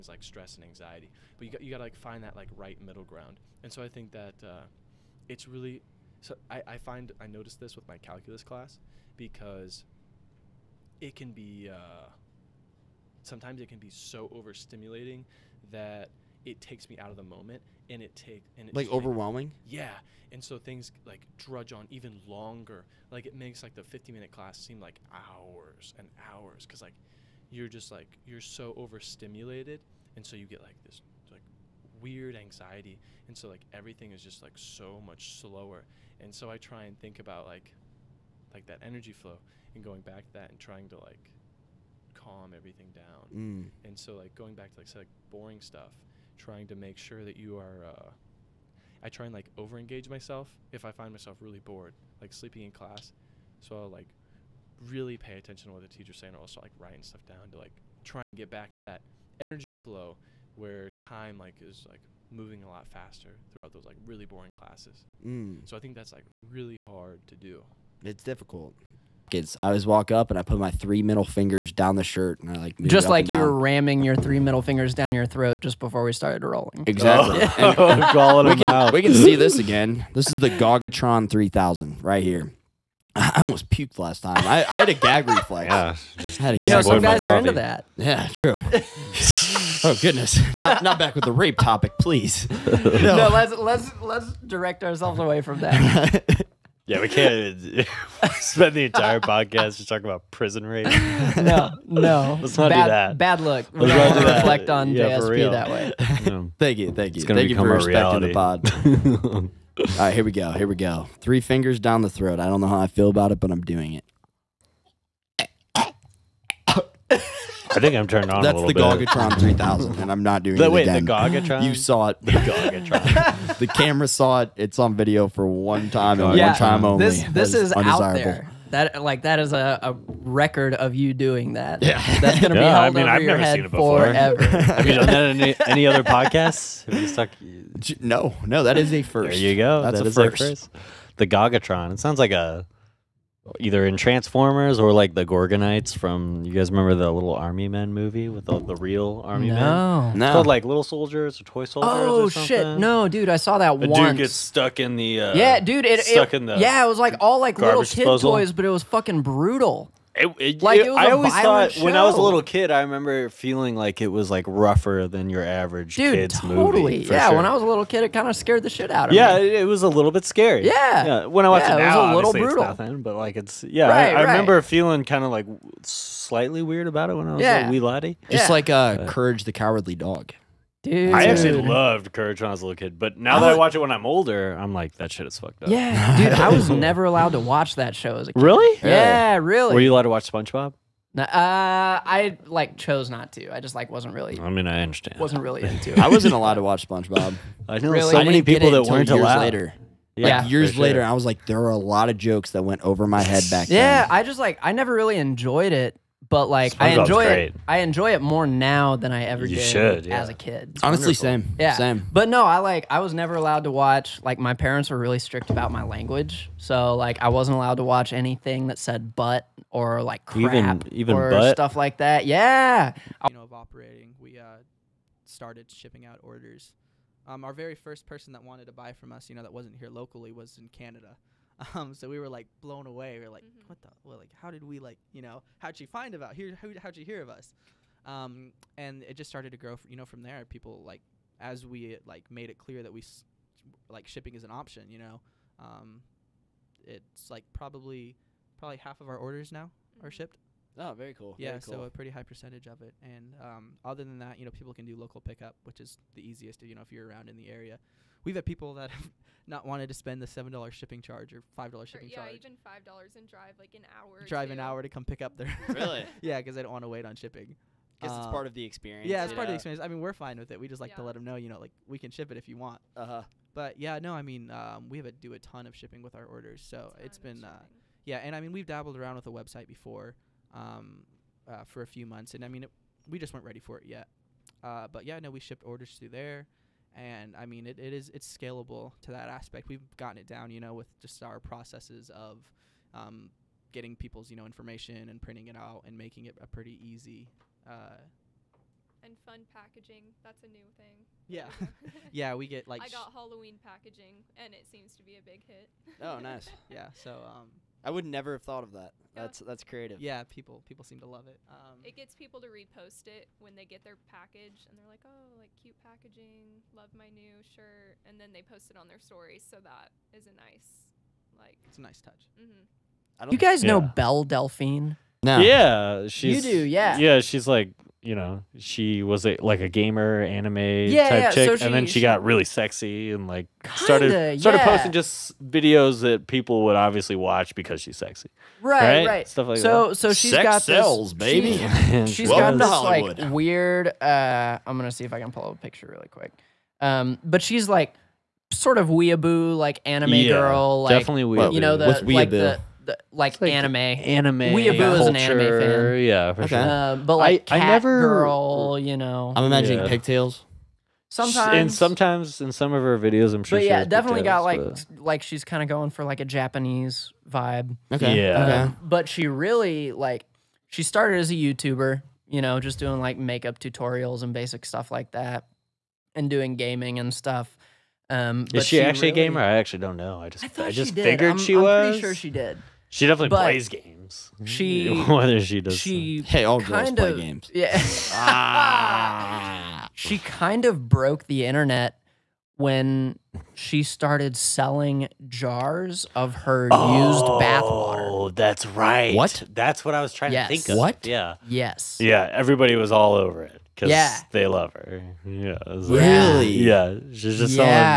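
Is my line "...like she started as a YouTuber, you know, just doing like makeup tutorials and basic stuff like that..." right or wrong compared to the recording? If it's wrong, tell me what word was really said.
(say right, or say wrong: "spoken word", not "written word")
right.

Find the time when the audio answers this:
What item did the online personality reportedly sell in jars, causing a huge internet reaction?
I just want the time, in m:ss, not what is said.
6:37.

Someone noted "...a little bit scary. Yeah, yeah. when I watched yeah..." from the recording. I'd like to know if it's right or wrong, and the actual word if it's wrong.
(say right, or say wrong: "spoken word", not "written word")
right.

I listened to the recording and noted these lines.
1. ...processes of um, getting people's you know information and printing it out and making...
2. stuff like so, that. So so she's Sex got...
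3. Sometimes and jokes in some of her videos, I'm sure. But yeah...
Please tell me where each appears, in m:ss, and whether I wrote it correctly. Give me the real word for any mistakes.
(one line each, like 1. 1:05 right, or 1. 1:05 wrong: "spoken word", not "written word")
1. 4:51 right
2. 5:39 right
3. 6:01 wrong: "sometimes", not "jokes".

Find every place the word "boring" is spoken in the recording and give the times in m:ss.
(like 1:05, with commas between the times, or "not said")
0:45, 1:04.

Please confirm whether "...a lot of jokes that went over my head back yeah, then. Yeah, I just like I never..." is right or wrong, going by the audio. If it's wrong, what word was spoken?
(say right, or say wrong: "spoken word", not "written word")
right.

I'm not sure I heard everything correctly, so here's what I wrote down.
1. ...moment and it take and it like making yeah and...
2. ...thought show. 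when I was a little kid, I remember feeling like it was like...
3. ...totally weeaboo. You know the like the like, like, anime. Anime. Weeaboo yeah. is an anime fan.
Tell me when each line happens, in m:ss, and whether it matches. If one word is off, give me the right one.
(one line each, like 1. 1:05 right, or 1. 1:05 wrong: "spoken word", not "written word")
1. 0:17 wrong: "overwhelming", not "making"
2. 2:41 right
3. 5:50 wrong: "definitely", not "totally".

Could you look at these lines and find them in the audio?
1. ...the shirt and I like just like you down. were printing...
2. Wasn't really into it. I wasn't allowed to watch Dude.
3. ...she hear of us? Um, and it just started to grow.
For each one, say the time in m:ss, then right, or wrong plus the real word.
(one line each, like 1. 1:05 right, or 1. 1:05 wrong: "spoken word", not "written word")
1. 1:11 wrong: "ramming", not "printing"
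2. 3:15 wrong: "SpongeBob", not "Dude"
3. 3:56 right.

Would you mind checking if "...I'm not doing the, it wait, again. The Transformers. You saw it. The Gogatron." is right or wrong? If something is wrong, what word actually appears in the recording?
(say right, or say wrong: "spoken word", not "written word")
wrong: "Gogatron", not "Transformers".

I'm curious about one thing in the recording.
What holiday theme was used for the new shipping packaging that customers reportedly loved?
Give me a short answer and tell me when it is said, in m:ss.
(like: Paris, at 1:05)
Halloween, at 5:03.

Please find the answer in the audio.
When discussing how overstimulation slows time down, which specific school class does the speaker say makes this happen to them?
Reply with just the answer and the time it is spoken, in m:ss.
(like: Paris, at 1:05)
Calculus, at 0:07.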